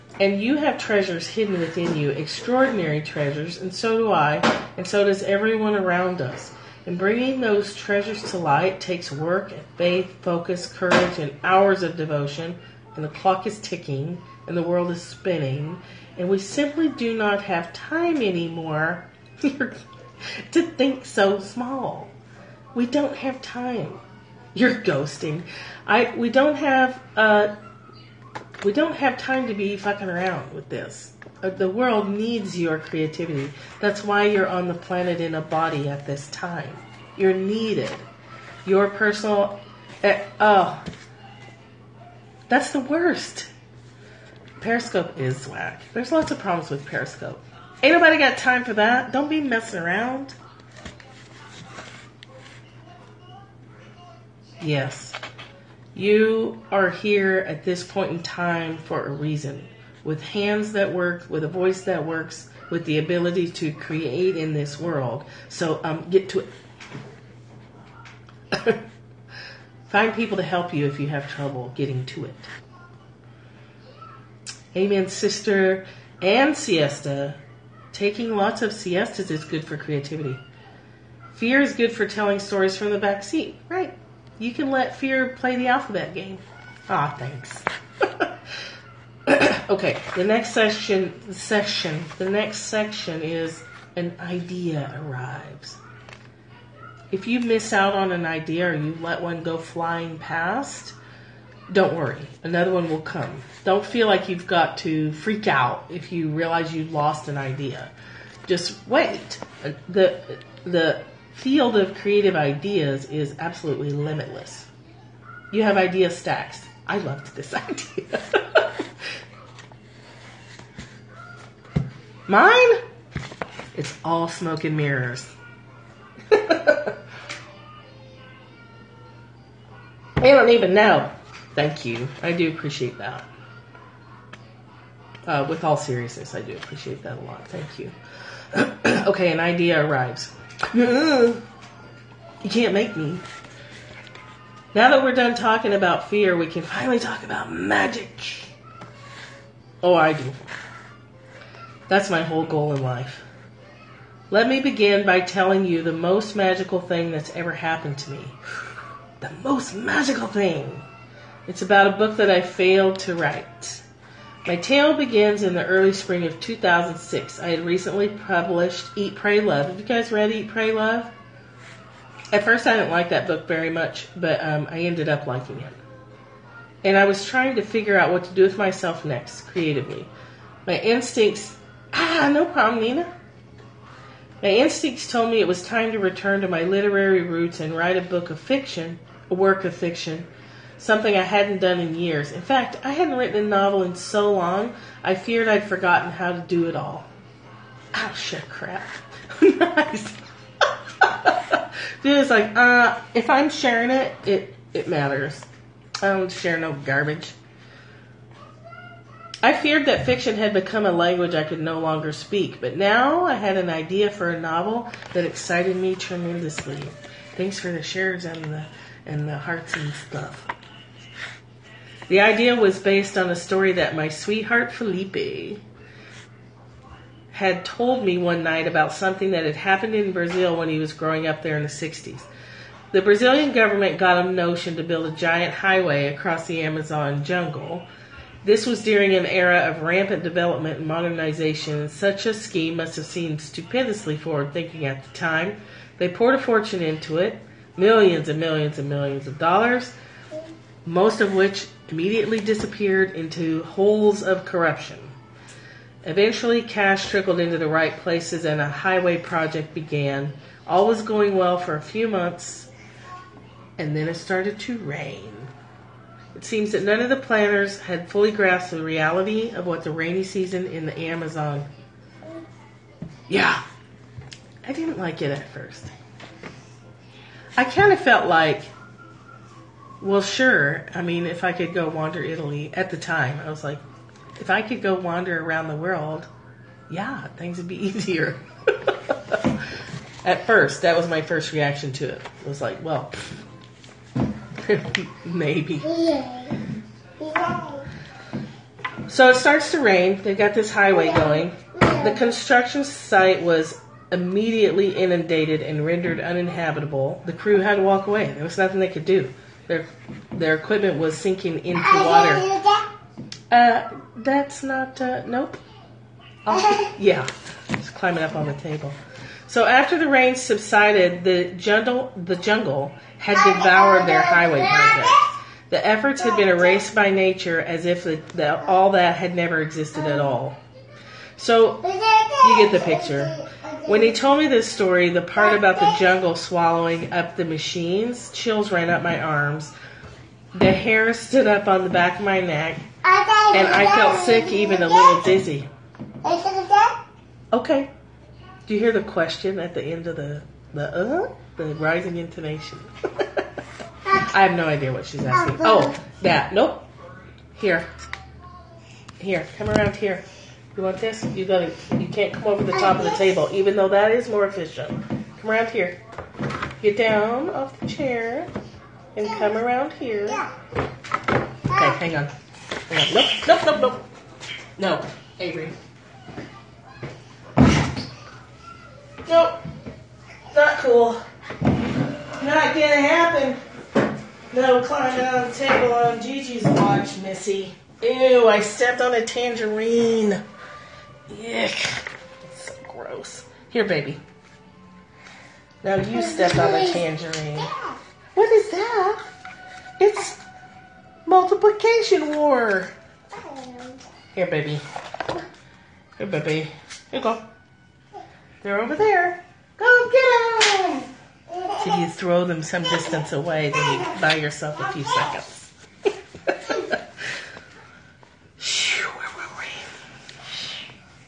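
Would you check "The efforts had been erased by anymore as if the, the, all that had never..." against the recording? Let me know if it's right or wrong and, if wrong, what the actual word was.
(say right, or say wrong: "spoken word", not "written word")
wrong: "nature", not "anymore".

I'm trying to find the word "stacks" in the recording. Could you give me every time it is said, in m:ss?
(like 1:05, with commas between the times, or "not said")
1:56.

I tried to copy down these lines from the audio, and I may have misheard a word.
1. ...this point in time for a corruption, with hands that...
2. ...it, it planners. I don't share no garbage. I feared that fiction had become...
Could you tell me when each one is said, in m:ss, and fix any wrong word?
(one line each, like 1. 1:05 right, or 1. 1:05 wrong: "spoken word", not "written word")
1. 0:57 wrong: "reason", not "corruption"
2. 3:24 wrong: "matters", not "planners".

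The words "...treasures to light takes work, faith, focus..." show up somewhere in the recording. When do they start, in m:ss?
0:07.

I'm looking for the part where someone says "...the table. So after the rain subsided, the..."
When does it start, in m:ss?
5:18.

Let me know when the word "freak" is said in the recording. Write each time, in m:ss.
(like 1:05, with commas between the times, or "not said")
1:45.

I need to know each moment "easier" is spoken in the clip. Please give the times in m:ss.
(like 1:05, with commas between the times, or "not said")
4:47.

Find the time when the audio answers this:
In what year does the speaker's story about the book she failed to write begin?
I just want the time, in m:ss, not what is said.
2:46.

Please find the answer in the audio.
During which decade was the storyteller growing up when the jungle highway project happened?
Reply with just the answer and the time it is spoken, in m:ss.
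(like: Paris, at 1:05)
the 60s, at 3:51.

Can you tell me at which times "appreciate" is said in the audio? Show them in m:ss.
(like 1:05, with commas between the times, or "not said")
2:12, 2:16.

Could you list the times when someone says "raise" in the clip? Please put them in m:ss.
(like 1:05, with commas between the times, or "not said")
not said.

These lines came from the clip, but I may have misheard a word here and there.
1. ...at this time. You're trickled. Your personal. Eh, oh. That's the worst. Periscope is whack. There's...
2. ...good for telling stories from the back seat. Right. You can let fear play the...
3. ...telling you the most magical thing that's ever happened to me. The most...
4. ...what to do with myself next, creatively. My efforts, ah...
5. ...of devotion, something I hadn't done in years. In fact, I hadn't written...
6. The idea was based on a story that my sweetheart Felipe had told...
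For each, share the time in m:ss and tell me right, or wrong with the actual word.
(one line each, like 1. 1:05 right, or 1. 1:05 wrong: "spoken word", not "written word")
1. 0:35 wrong: "needed", not "trickled"
2. 1:21 right
3. 2:35 right
4. 2:58 wrong: "instincts", not "efforts"
5. 3:09 wrong: "fiction", not "devotion"
6. 3:42 right.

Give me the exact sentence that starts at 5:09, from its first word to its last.
Their their equipment was sinking into water.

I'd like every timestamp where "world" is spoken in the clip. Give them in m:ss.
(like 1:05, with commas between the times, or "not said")
0:14, 0:31, 1:04, 4:45.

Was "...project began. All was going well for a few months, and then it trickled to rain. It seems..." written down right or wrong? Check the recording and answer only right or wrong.
wrong.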